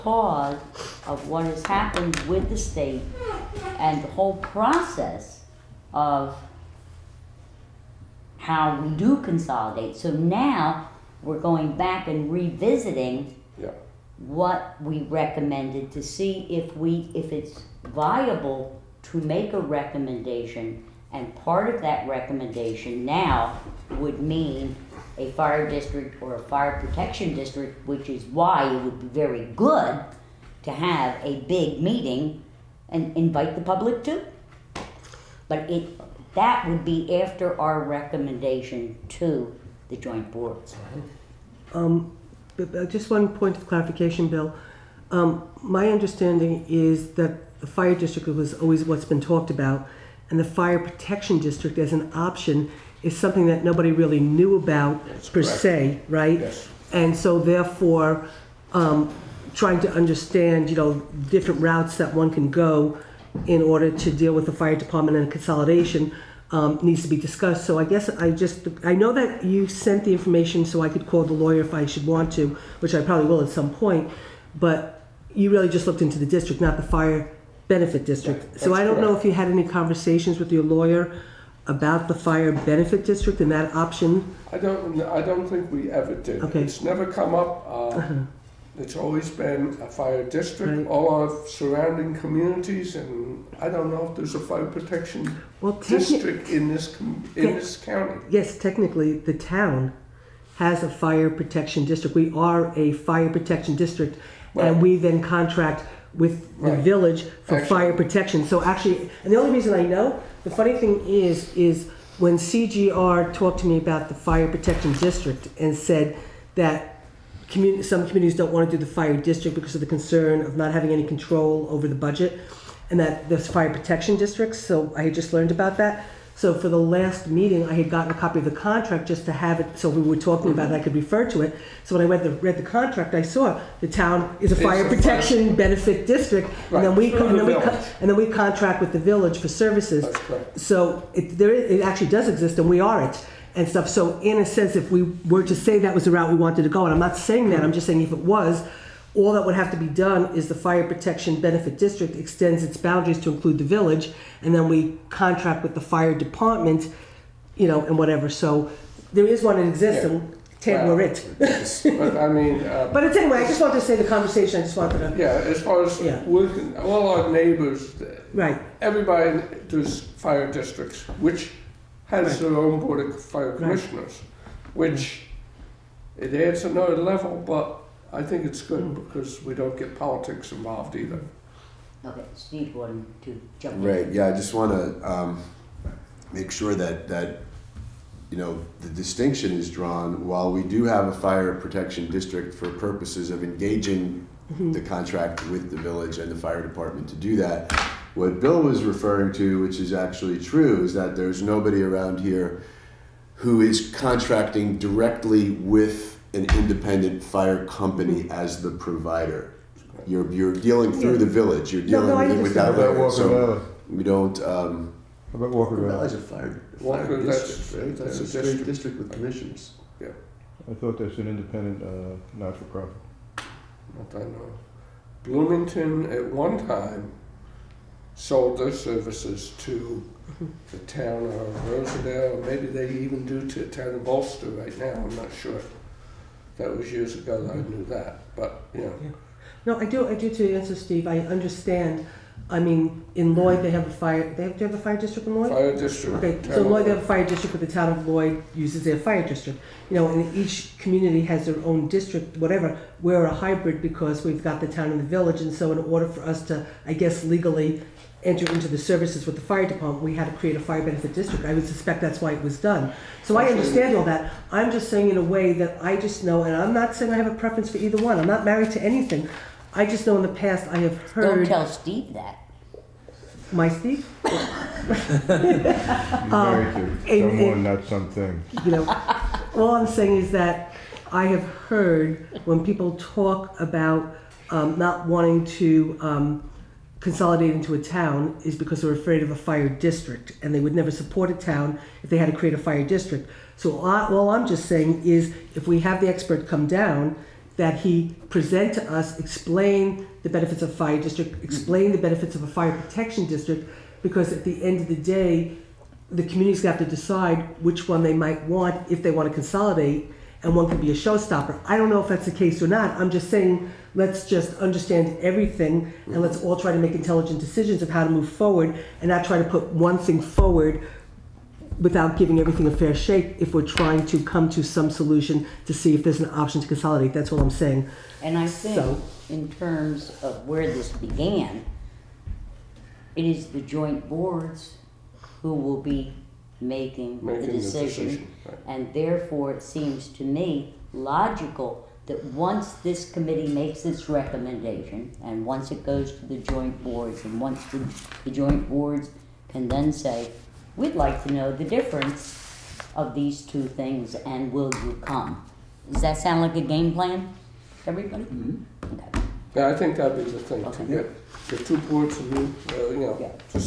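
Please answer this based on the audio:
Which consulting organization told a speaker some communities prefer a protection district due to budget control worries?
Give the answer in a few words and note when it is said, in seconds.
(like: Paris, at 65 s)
CGR, at 112 s.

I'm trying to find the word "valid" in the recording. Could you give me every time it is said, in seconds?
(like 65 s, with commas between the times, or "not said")
not said.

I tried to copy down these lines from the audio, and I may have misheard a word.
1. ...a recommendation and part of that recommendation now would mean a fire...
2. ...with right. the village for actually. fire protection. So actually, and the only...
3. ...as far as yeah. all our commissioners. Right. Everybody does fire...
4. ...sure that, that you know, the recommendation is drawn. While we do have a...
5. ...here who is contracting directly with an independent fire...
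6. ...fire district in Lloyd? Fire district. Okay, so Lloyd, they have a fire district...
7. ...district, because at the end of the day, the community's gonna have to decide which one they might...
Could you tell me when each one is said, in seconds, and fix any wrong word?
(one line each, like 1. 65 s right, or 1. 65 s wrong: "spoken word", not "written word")
1. 19 s right
2. 106 s right
3. 165 s wrong: "neighbors", not "commissioners"
4. 186 s wrong: "distinction", not "recommendation"
5. 202 s right
6. 244 s right
7. 303 s right.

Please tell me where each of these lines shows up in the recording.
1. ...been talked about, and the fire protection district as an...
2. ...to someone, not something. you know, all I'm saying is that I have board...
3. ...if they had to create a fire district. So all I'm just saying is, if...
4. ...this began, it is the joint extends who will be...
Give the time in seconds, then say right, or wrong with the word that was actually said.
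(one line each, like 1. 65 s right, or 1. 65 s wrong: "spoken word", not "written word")
1. 49 s right
2. 276 s wrong: "heard", not "board"
3. 292 s right
4. 330 s wrong: "boards", not "extends".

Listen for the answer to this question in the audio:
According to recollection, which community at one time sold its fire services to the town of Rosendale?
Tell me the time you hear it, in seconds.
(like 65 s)
225 s.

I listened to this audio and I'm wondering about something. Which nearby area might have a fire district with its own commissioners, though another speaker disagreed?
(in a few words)
Walker Valley.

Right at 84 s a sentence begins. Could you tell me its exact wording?
I don't, I don't think we ever did.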